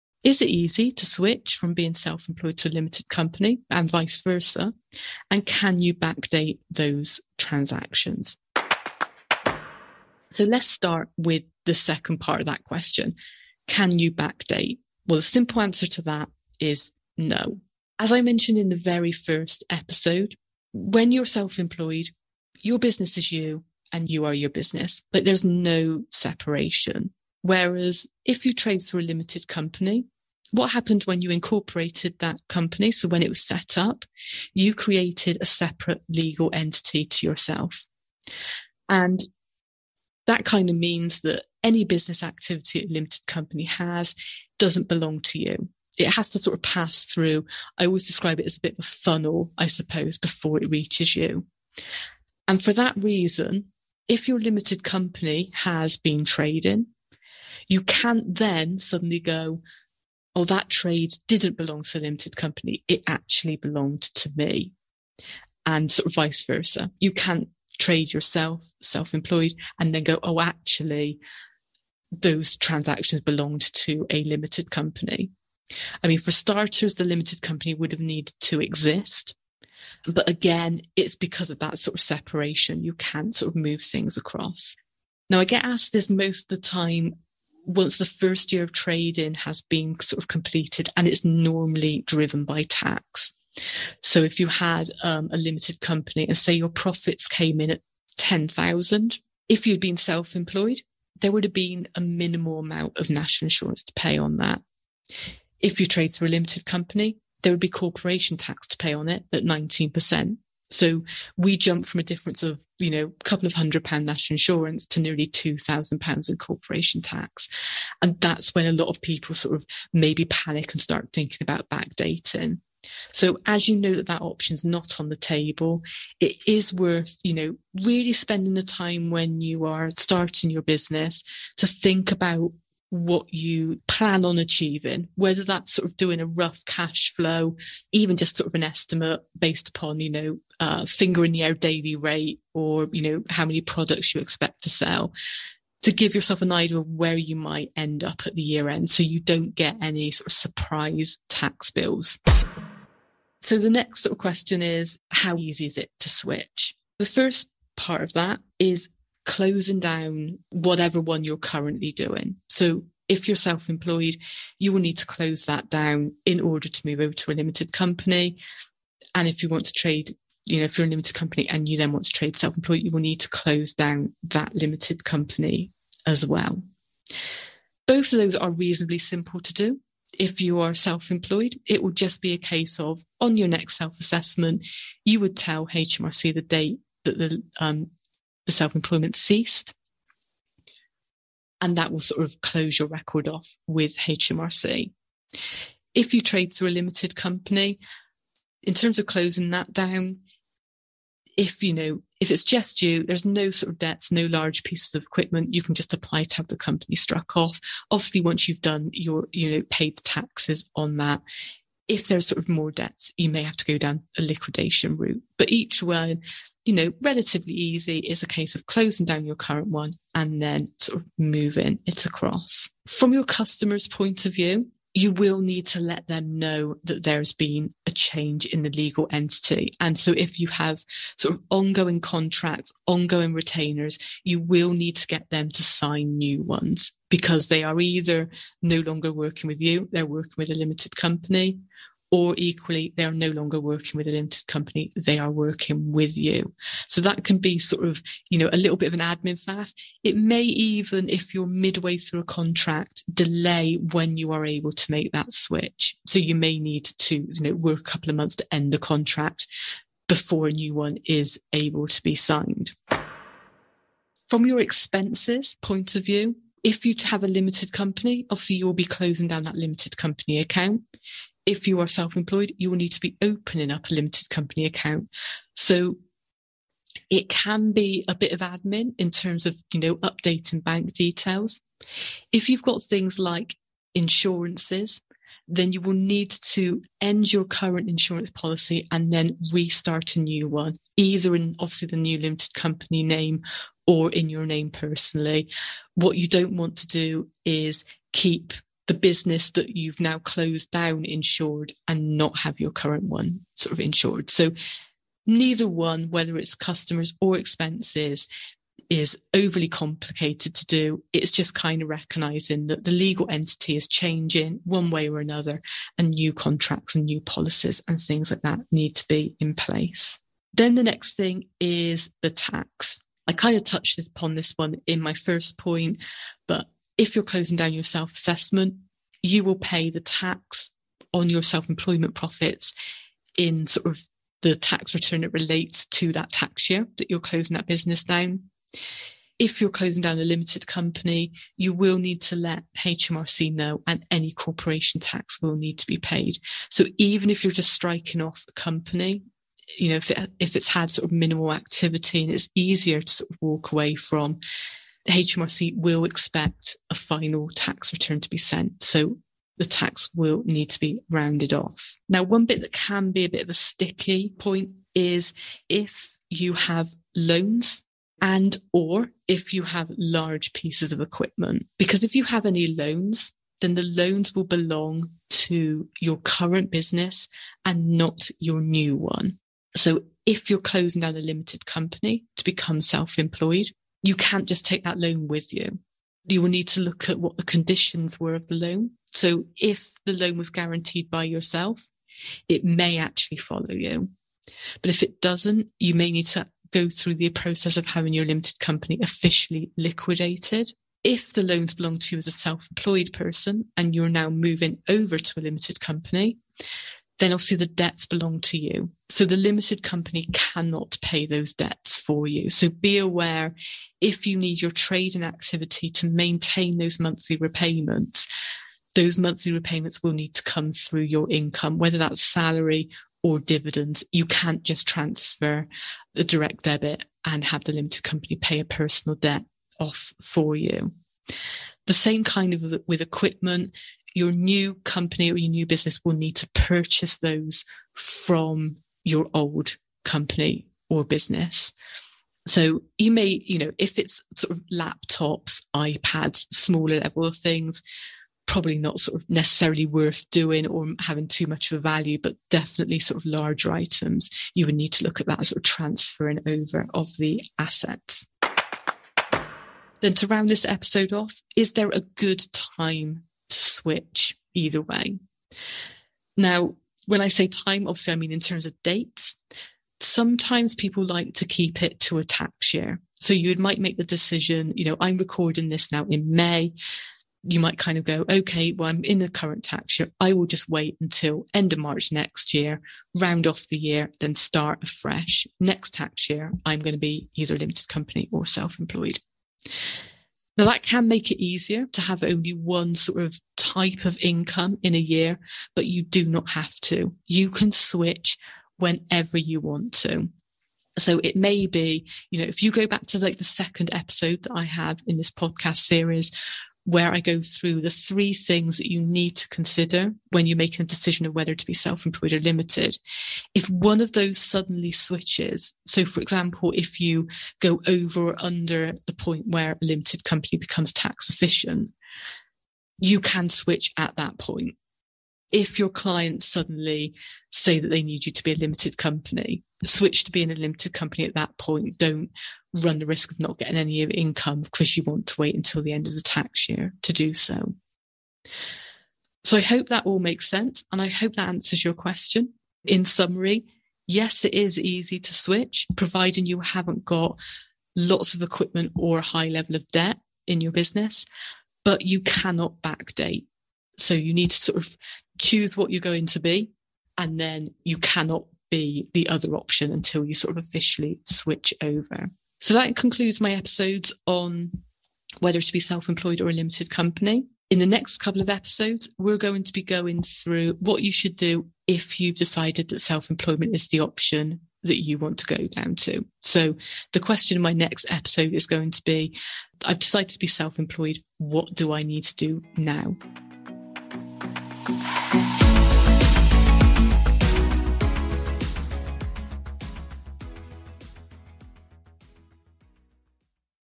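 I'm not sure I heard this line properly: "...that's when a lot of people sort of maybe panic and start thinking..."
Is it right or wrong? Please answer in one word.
right.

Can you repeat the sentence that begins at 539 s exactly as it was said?
So I hope that all makes sense.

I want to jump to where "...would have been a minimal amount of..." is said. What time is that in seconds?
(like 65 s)
101 s.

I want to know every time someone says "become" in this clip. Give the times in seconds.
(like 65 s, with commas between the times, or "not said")
382 s, 520 s.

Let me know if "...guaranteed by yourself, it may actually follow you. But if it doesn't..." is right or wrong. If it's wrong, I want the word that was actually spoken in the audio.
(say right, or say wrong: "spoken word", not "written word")
right.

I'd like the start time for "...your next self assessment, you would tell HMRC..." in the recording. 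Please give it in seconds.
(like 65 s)
183 s.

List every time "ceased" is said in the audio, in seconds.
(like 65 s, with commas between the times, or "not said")
189 s.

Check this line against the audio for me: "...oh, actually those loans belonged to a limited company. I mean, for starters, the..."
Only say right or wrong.
wrong.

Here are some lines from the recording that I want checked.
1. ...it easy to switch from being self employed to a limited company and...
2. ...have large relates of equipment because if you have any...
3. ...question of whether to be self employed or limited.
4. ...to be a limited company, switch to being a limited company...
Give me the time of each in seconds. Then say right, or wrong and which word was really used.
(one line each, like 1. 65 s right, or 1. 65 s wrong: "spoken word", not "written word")
1. 0 s right
2. 369 s wrong: "pieces", not "relates"
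3. 510 s wrong: "decision", not "question"
4. 528 s right.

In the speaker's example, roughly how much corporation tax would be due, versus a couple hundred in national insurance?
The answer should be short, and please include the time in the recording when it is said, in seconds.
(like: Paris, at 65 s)
Nearly 2,000 pounds, at 115 s.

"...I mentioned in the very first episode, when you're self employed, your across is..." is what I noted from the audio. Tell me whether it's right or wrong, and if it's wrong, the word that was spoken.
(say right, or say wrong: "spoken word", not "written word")
wrong: "business", not "across".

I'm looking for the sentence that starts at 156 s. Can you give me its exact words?
The first part of that is closing down whatever one you're currently doing.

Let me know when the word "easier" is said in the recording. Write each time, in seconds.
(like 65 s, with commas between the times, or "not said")
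352 s, 491 s.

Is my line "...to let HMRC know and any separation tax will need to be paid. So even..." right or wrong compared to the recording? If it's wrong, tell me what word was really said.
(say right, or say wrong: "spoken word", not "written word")
wrong: "corporation", not "separation".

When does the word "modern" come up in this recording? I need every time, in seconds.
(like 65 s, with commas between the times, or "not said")
not said.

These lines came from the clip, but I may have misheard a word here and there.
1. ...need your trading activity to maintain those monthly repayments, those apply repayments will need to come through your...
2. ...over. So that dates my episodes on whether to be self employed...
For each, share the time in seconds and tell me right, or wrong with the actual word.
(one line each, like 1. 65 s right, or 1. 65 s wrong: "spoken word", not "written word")
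1. 414 s wrong: "monthly", not "apply"
2. 561 s wrong: "concludes", not "dates".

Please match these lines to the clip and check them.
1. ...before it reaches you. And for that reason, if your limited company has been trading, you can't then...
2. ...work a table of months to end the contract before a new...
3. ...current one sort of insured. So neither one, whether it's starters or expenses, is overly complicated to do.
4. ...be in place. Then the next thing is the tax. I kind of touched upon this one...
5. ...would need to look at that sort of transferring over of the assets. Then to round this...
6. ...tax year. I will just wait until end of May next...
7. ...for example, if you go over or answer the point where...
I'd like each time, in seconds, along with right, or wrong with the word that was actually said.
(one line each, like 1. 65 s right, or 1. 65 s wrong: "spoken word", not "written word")
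1. 50 s right
2. 257 s wrong: "couple", not "table"
3. 302 s wrong: "customers", not "starters"
4. 319 s right
5. 454 s right
6. 479 s wrong: "March", not "May"
7. 516 s wrong: "under", not "answer".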